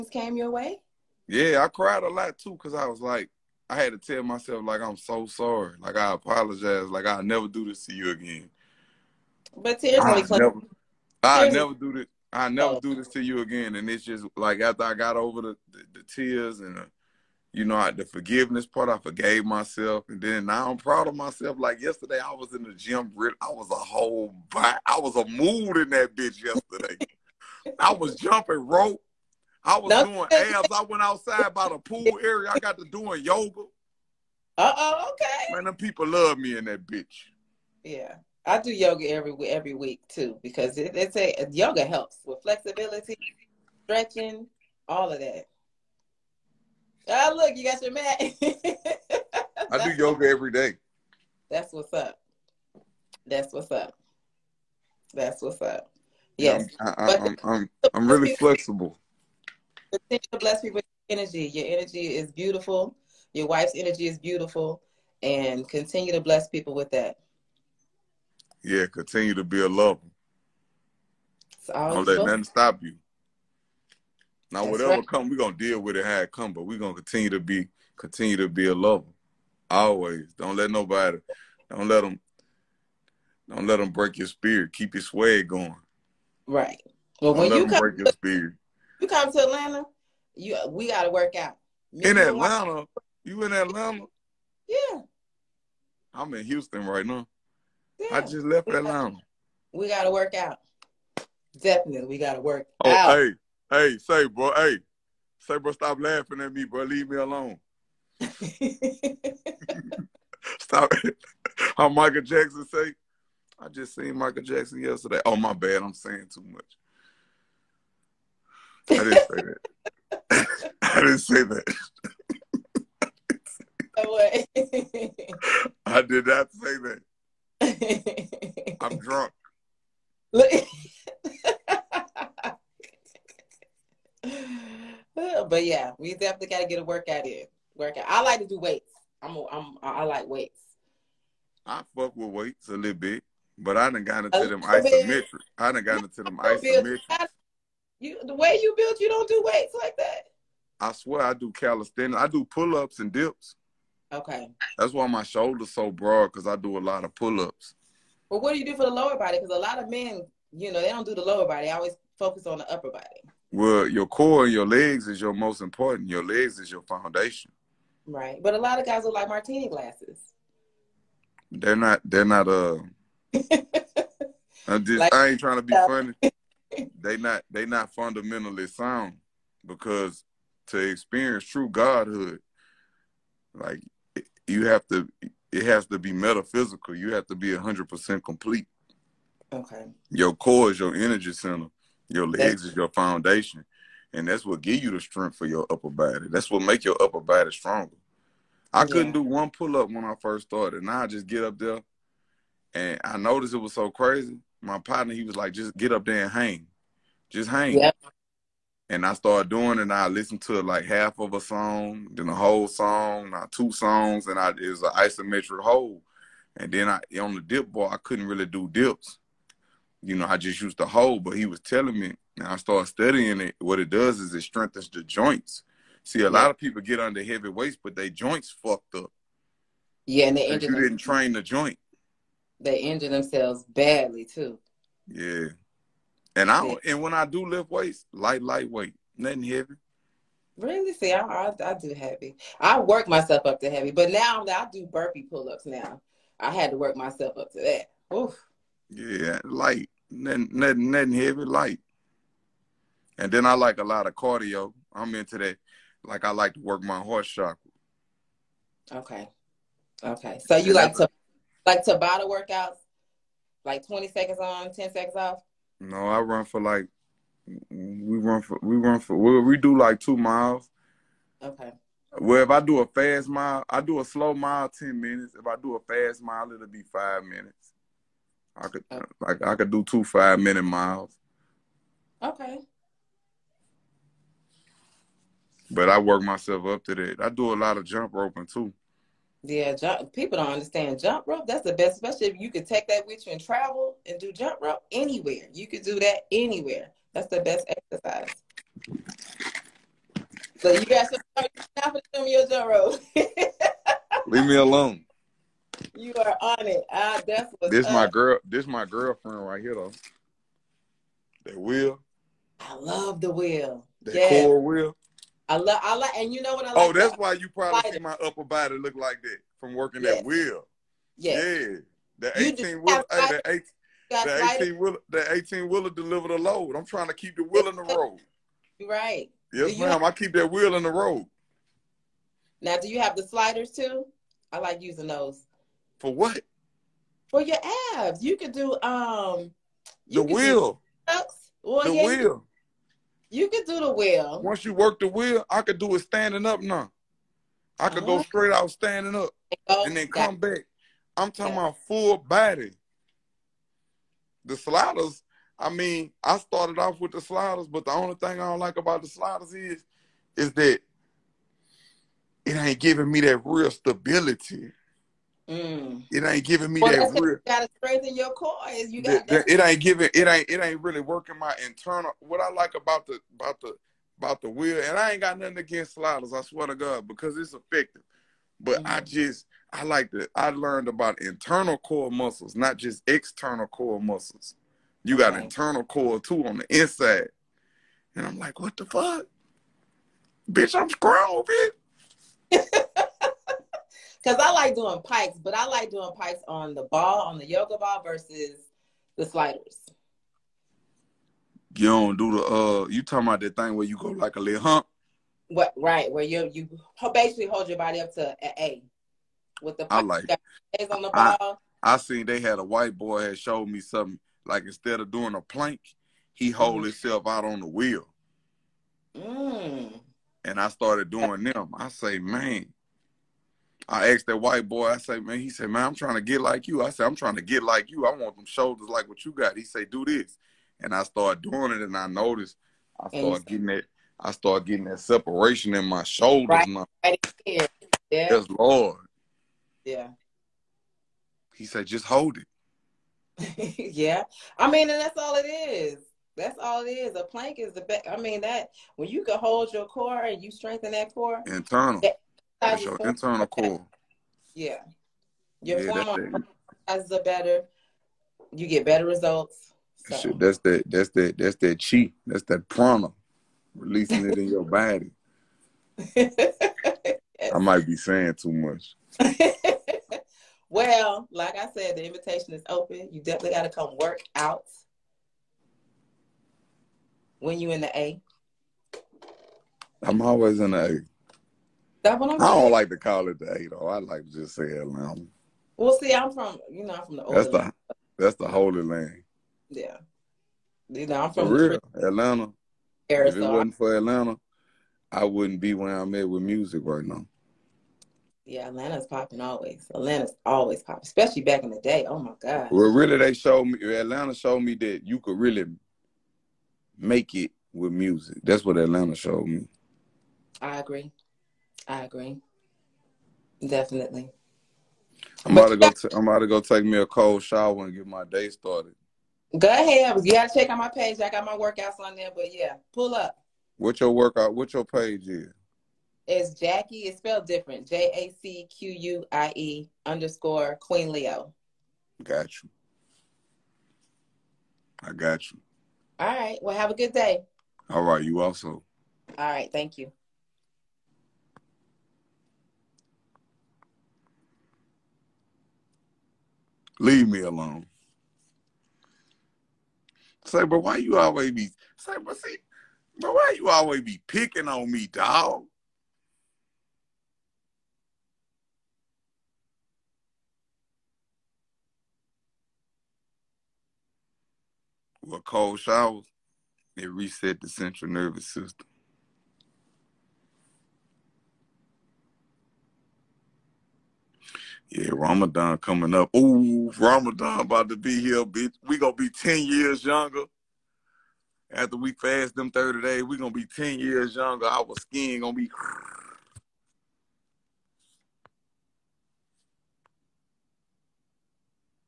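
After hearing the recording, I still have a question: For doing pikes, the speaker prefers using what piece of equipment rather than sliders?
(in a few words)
yoga ball.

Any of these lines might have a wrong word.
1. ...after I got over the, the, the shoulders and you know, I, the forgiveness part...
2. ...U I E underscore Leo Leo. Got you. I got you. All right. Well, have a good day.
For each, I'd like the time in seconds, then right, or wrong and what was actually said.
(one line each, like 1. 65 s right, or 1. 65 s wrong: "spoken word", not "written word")
1. 14 s wrong: "tears", not "shoulders"
2. 528 s wrong: "Queen", not "Leo".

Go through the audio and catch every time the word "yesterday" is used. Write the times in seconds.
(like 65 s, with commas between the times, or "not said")
21 s, 26 s, 114 s.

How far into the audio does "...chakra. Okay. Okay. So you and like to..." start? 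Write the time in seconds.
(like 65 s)
257 s.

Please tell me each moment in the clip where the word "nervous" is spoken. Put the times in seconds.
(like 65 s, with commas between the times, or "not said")
568 s.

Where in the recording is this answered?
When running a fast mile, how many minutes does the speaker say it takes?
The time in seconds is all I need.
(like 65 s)
276 s.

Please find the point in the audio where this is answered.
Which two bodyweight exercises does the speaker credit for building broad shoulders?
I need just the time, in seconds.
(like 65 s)
152 s.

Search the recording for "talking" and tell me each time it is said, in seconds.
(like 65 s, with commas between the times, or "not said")
351 s, 403 s.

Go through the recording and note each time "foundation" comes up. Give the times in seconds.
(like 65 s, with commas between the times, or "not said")
166 s, 192 s.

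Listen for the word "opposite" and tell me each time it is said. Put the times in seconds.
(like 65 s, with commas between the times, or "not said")
not said.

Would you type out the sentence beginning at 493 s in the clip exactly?
If it wasn't for Atlanta, I wouldn't be where I'm at with music right now.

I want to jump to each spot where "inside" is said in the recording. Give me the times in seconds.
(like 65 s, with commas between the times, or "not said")
386 s.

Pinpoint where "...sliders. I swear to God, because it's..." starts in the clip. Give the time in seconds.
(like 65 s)
375 s.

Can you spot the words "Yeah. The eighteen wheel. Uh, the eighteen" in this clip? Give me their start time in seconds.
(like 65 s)
321 s.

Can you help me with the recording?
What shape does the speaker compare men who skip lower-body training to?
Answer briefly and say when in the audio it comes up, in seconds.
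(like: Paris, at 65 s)
martini glasses, at 169 s.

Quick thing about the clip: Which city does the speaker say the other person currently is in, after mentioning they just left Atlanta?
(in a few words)
Houston.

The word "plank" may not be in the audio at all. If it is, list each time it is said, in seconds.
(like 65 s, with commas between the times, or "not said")
415 s, 447 s.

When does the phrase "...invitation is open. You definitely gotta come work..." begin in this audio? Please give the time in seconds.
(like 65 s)
472 s.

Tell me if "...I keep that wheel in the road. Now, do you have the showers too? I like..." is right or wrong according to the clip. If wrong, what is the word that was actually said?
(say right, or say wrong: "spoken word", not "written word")
wrong: "sliders", not "showers".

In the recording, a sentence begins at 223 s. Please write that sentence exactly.
What it does is it strengthens the joints.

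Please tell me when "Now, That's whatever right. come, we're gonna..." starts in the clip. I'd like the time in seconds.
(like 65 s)
74 s.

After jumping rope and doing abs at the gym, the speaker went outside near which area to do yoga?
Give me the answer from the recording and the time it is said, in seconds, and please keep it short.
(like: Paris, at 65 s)
pool area, at 31 s.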